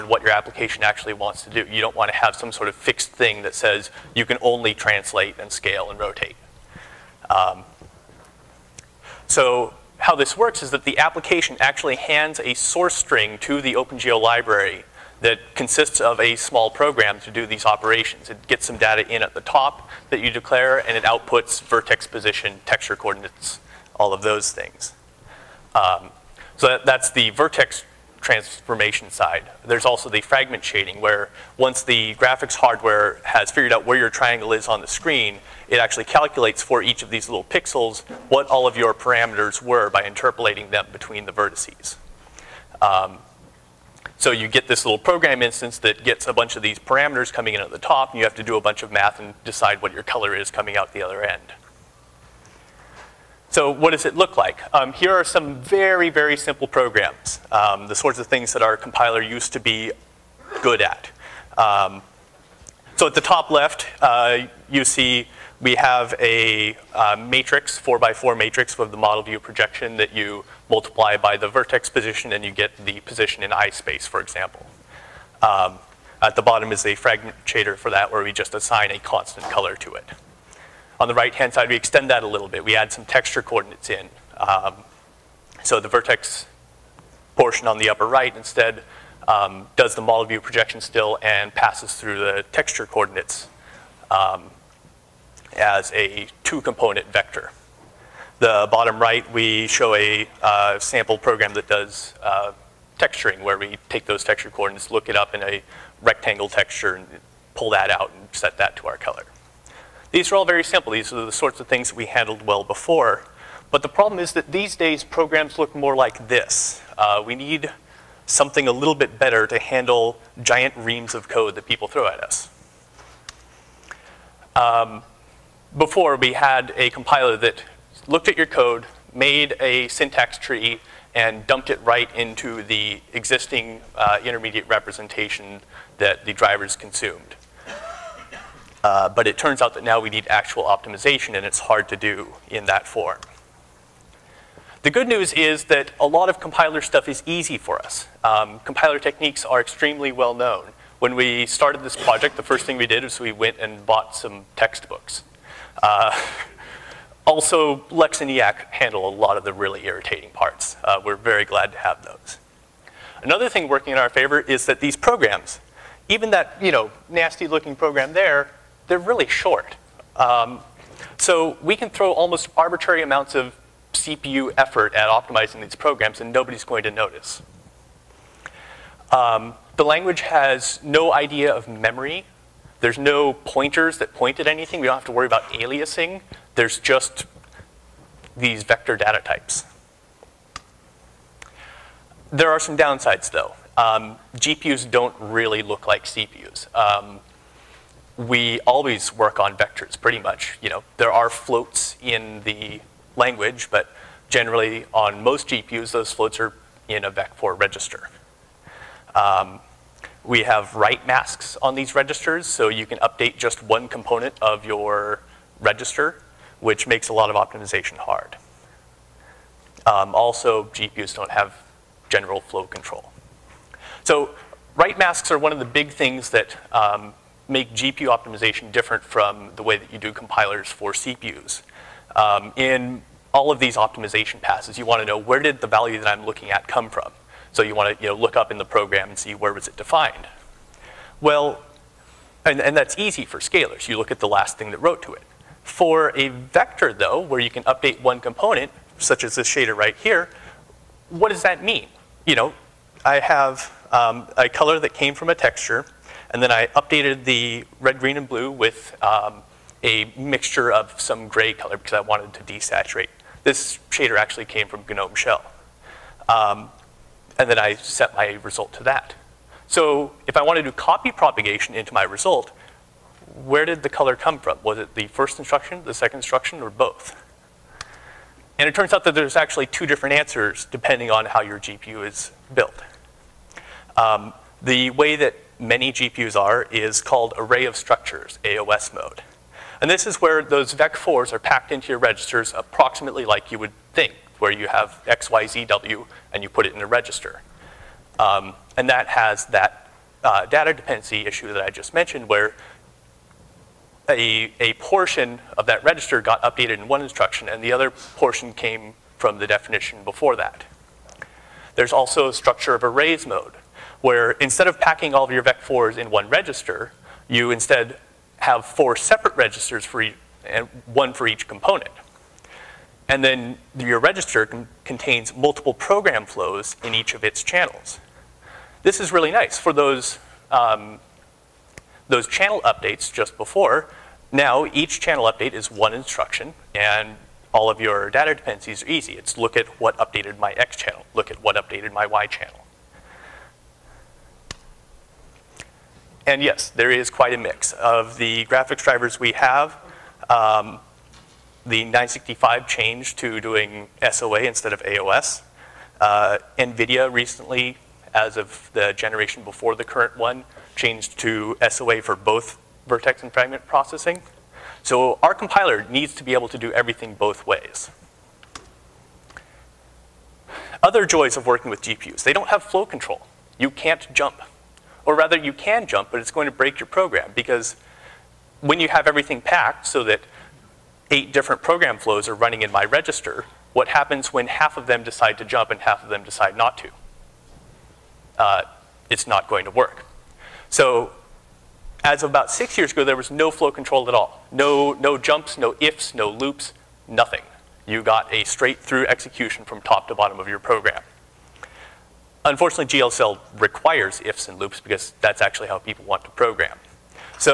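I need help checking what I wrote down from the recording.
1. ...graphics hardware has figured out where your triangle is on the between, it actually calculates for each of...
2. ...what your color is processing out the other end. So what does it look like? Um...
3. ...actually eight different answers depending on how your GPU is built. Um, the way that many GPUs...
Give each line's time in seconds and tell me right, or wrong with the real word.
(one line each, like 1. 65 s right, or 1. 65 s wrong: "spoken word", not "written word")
1. 32 s wrong: "screen", not "between"
2. 49 s wrong: "coming", not "processing"
3. 279 s wrong: "two", not "eight".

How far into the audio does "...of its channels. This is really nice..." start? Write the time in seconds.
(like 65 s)
327 s.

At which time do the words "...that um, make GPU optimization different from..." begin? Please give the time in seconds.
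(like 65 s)
226 s.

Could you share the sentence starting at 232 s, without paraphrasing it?
Um, in all of these optimization passes, you want to know where did the value that I'm looking at come from.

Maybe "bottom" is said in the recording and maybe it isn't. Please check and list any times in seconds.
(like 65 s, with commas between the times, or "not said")
76 s, 98 s, 400 s.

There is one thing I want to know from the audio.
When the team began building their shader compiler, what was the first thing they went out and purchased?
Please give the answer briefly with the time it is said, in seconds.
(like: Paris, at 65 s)
Textbooks, at 154 s.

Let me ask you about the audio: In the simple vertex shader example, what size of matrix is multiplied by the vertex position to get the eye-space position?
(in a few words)
4 by 4.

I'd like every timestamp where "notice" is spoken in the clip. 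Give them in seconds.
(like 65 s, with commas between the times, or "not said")
176 s.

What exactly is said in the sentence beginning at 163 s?
Another thing working in our favor is that these programs, even that you know nasty looking program there, they're really short.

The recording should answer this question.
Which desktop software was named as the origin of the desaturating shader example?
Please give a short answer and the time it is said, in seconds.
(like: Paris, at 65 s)
GNOME Shell, at 264 s.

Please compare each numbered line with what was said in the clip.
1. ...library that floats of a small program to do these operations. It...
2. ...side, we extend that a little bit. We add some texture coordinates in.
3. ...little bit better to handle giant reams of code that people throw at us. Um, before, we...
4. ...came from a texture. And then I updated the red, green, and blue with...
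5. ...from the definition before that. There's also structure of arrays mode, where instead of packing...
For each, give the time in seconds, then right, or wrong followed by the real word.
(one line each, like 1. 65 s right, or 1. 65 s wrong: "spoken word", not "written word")
1. 14 s wrong: "consists", not "floats"
2. 81 s right
3. 118 s right
4. 254 s right
5. 309 s right.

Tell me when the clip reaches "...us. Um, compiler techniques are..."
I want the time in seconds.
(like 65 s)
147 s.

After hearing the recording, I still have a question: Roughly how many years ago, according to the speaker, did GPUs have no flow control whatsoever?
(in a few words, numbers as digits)
6.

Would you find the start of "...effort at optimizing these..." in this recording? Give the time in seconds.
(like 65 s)
174 s.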